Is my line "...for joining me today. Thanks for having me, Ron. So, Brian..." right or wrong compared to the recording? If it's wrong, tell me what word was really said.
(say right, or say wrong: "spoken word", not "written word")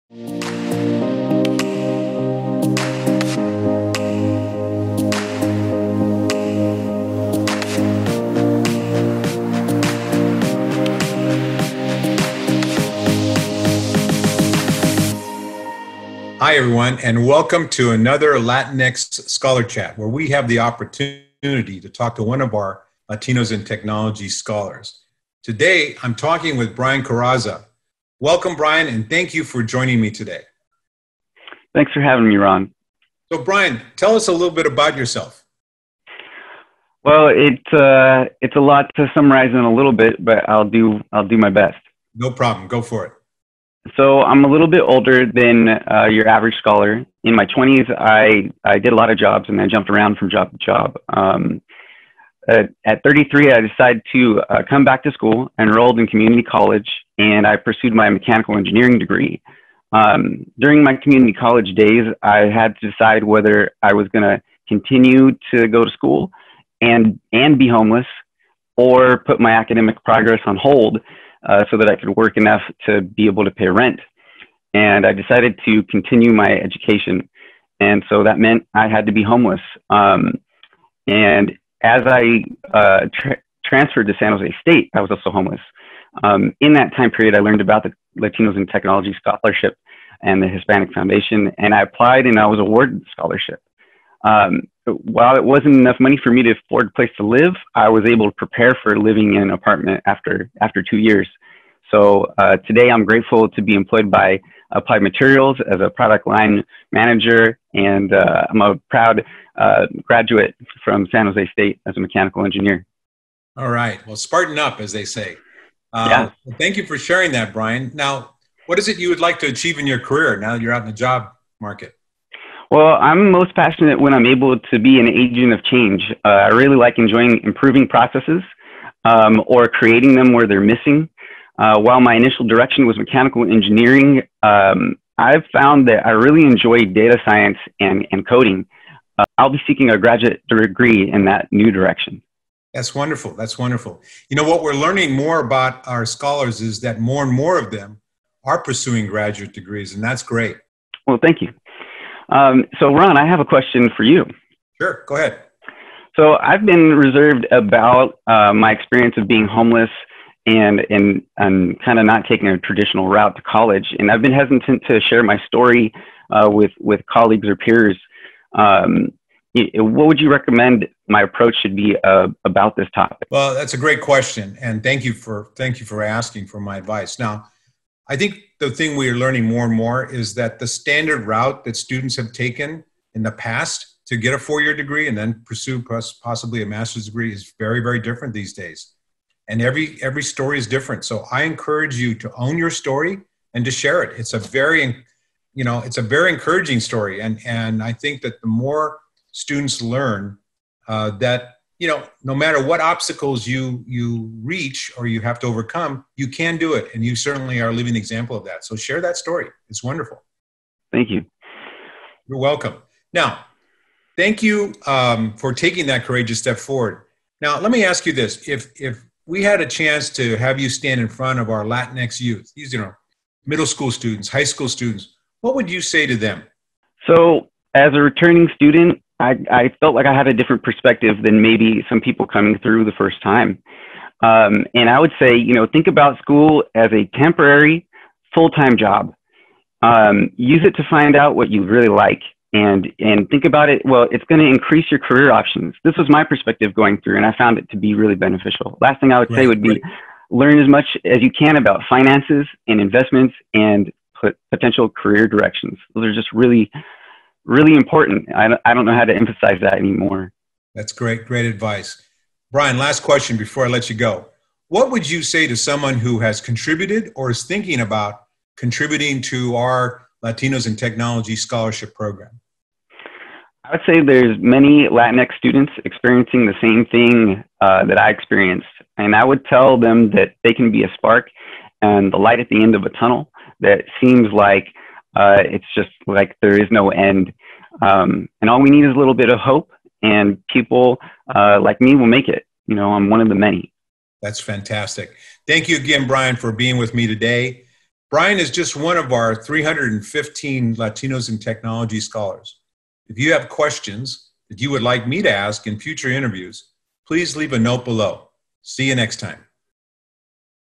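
right.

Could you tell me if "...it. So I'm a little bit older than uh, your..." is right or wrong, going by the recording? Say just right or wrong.
right.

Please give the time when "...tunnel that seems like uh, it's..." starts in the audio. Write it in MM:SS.
04:42.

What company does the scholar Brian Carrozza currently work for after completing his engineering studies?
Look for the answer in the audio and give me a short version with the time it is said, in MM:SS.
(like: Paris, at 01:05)
Applied Materials, at 01:44.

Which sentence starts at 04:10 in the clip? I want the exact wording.
learn as much as you can about finances and investments and potential career directions.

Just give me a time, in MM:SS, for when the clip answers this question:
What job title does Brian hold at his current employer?
01:45.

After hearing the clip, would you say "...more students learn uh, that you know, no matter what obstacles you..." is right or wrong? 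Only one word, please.
right.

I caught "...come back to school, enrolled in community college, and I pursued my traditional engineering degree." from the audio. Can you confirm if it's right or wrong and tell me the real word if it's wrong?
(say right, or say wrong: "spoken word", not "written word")
wrong: "mechanical", not "traditional".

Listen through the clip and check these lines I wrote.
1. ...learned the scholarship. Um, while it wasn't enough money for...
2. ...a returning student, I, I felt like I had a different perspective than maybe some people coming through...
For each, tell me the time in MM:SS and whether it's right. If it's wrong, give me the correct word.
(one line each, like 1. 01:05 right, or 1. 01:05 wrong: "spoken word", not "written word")
1. 01:32 wrong: "awarded", not "learned"
2. 03:47 right.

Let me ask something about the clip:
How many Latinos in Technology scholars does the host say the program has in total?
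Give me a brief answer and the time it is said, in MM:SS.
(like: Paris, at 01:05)
315, at 04:59.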